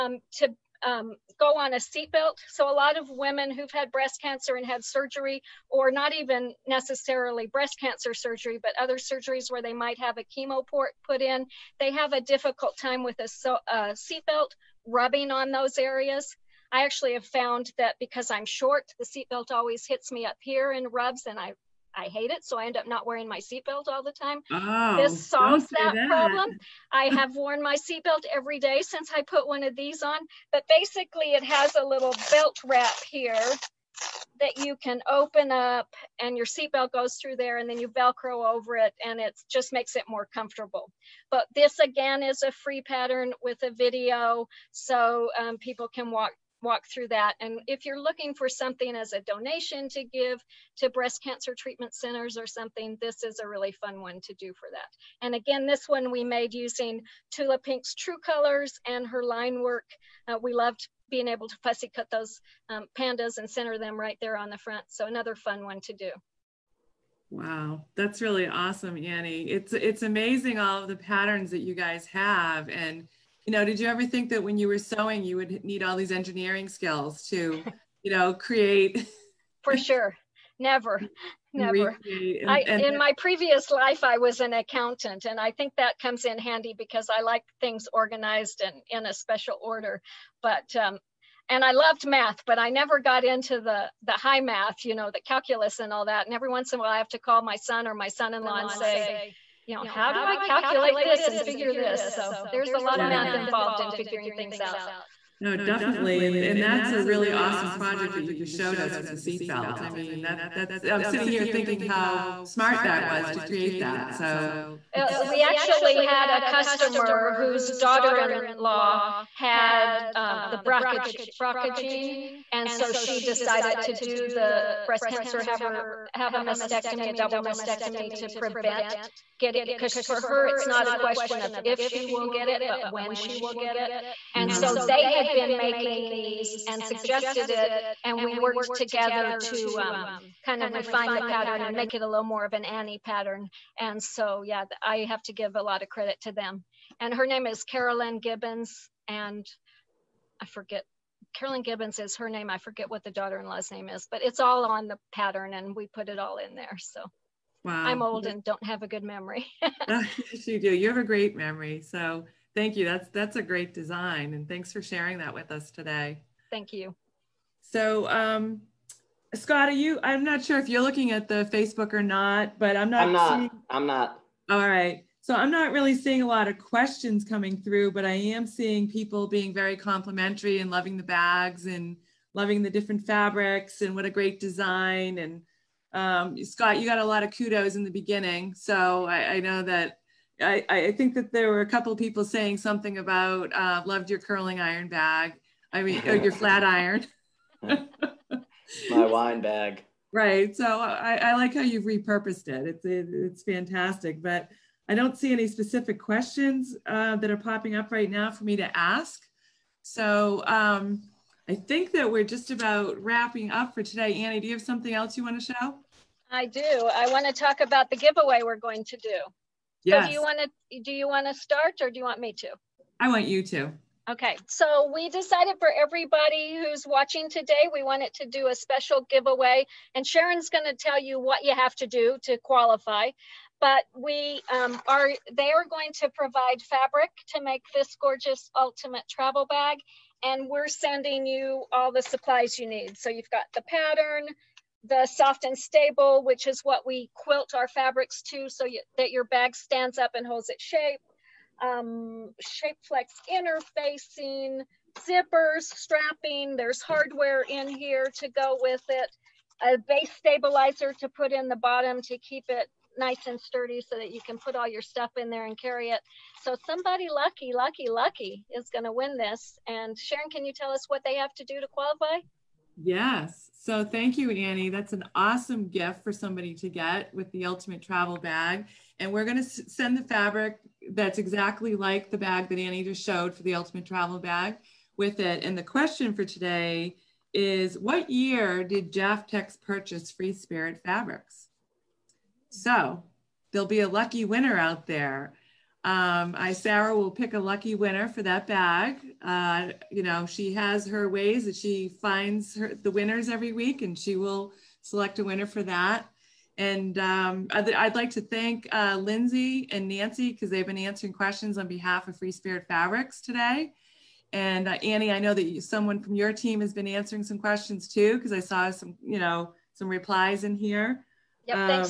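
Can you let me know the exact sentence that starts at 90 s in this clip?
But um, and I loved math, but I never got into the the high math, you know, the calculus and all that.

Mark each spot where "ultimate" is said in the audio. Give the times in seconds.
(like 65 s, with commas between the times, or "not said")
238 s, 277 s, 283 s.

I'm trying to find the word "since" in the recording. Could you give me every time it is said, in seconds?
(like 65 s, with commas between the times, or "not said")
28 s.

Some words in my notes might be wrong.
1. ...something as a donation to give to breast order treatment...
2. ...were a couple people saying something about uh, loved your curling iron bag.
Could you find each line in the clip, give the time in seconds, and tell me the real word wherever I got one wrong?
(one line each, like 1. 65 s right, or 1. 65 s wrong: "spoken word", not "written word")
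1. 48 s wrong: "cancer", not "order"
2. 191 s right.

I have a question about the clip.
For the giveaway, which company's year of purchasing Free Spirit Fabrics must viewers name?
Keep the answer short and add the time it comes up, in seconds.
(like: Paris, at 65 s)
Jaftex, at 288 s.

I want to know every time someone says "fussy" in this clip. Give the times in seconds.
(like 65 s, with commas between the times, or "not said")
61 s.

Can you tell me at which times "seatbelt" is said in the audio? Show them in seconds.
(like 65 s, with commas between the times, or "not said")
1 s, 13 s, 19 s, 23 s, 27 s, 36 s, 109 s.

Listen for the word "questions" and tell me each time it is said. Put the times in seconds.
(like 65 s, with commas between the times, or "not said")
130 s, 176 s, 205 s, 285 s, 311 s, 317 s.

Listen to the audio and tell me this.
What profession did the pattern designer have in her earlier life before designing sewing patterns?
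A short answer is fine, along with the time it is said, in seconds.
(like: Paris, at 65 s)
Accountant, at 84 s.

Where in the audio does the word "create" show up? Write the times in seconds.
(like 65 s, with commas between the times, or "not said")
78 s, 113 s.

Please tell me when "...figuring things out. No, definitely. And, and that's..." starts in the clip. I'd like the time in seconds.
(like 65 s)
103 s.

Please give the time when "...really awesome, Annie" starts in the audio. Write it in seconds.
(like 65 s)
68 s.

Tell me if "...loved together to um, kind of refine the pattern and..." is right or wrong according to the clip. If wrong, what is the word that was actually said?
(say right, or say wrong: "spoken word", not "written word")
wrong: "worked", not "loved".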